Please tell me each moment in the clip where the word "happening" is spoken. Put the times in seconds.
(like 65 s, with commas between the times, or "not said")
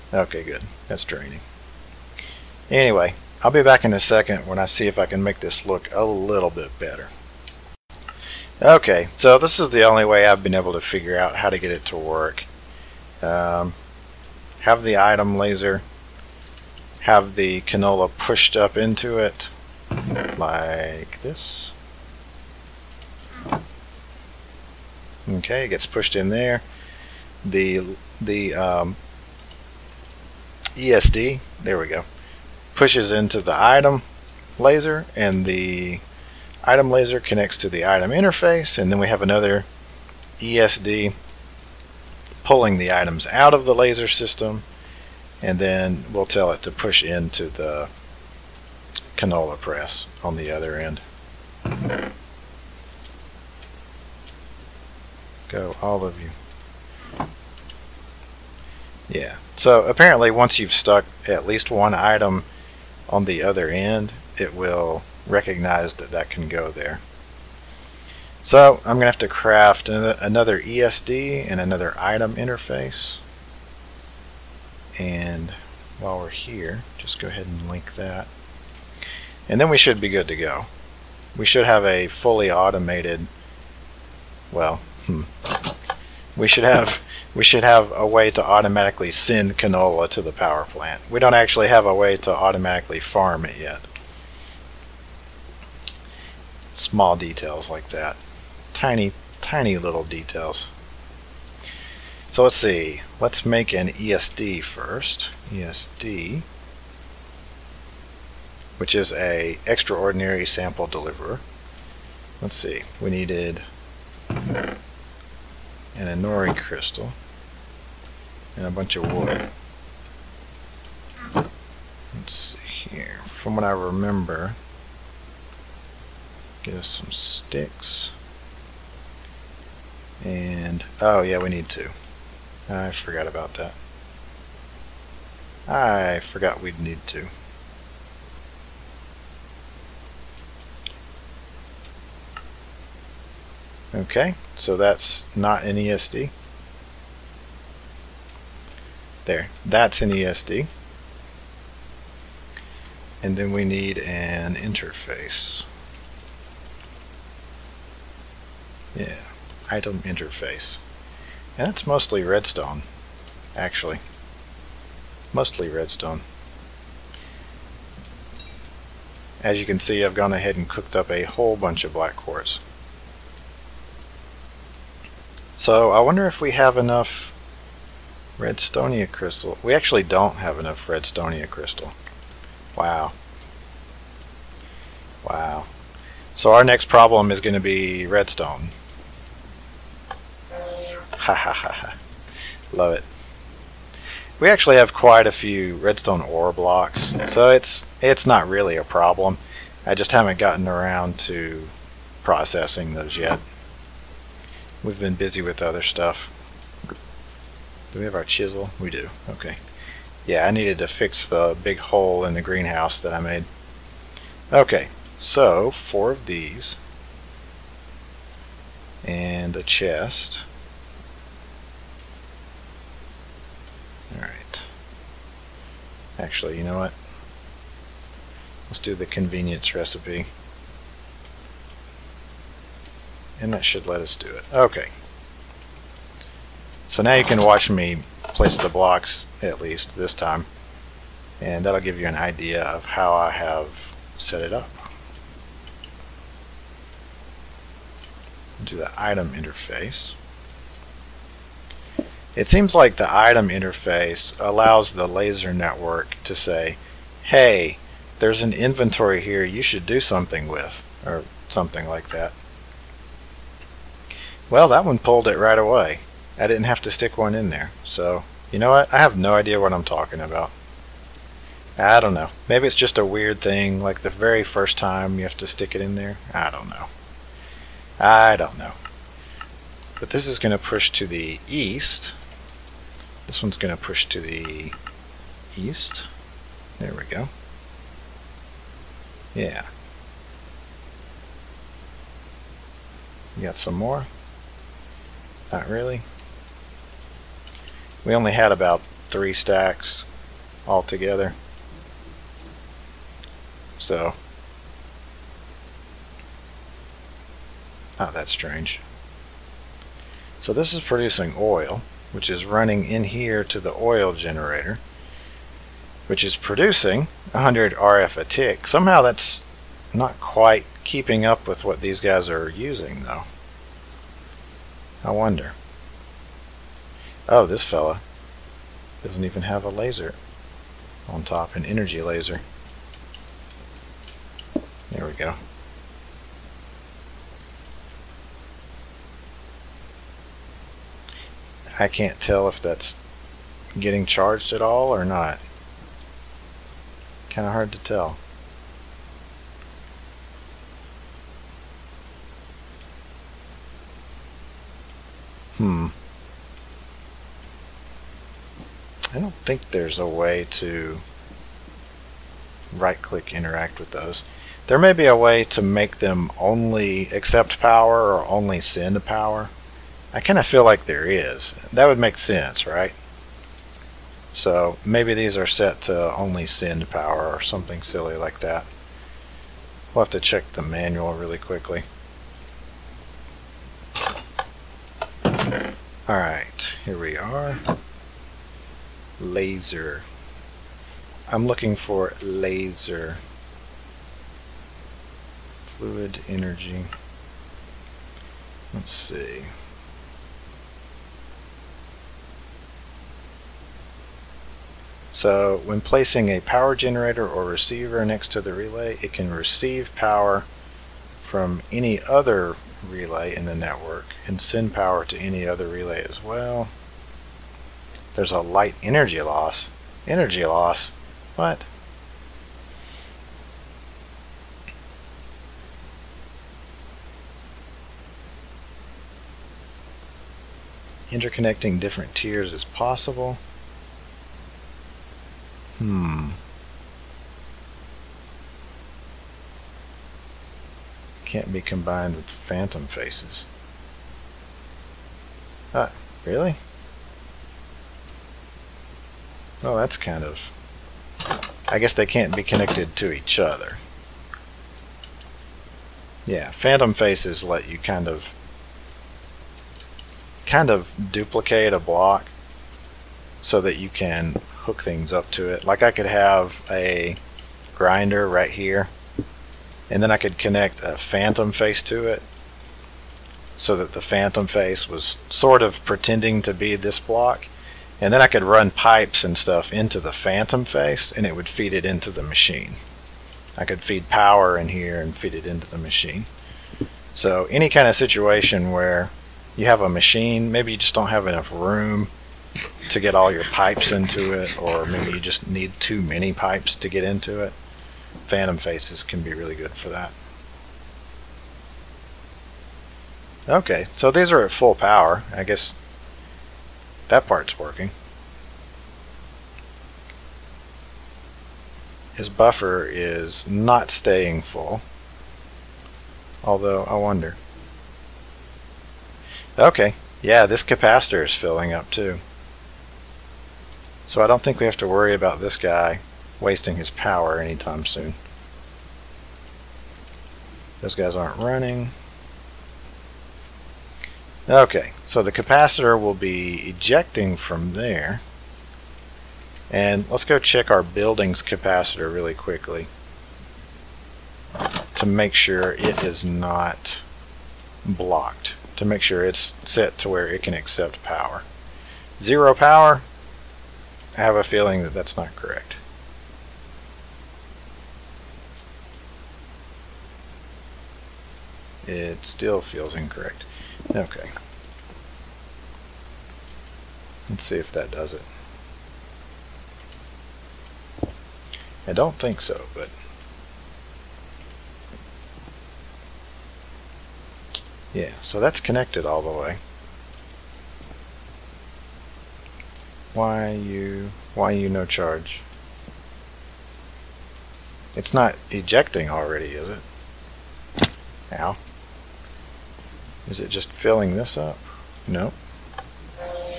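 not said.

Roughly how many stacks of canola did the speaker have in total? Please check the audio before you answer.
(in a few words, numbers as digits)
3 stacks.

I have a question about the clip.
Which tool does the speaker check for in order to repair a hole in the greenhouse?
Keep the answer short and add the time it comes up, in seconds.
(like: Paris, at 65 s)
Chisel, at 208 s.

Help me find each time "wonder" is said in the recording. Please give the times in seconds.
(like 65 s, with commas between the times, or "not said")
175 s, 325 s, 516 s.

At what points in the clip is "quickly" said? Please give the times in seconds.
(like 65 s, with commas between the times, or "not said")
381 s, 542 s.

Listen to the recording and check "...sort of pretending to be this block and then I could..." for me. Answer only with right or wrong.
right.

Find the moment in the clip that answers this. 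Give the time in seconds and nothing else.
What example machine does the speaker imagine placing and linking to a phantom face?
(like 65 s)
467 s.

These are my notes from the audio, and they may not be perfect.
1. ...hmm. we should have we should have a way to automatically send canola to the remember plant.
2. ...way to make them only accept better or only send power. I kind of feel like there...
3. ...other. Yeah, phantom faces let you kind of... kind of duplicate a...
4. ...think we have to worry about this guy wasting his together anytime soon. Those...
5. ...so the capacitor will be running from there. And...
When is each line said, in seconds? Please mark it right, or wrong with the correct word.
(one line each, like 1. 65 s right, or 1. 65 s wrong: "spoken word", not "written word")
1. 85 s wrong: "power", not "remember"
2. 365 s wrong: "power", not "better"
3. 453 s right
4. 524 s wrong: "power", not "together"
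5. 535 s wrong: "ejecting", not "running".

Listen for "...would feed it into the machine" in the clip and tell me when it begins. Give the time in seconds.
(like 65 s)
481 s.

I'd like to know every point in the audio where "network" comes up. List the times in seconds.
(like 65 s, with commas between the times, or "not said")
255 s, 413 s.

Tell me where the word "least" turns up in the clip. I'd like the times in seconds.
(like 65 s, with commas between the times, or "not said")
61 s, 239 s.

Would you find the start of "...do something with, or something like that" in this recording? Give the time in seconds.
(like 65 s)
259 s.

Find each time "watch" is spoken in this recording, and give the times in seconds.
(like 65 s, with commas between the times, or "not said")
237 s.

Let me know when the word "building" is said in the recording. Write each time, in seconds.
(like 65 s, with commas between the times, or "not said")
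540 s.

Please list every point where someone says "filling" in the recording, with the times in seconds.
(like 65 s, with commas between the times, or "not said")
521 s, 593 s.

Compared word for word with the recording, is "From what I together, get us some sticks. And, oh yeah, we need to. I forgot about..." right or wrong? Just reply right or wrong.
wrong.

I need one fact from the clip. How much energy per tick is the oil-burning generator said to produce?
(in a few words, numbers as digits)
100 RF.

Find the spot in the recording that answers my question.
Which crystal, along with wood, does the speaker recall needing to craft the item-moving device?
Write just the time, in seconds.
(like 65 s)
115 s.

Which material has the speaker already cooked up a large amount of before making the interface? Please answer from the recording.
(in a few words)
Black quartz.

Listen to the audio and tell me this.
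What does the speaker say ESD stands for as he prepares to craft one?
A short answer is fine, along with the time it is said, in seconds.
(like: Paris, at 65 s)
Extraordinary sample deliverer, at 109 s.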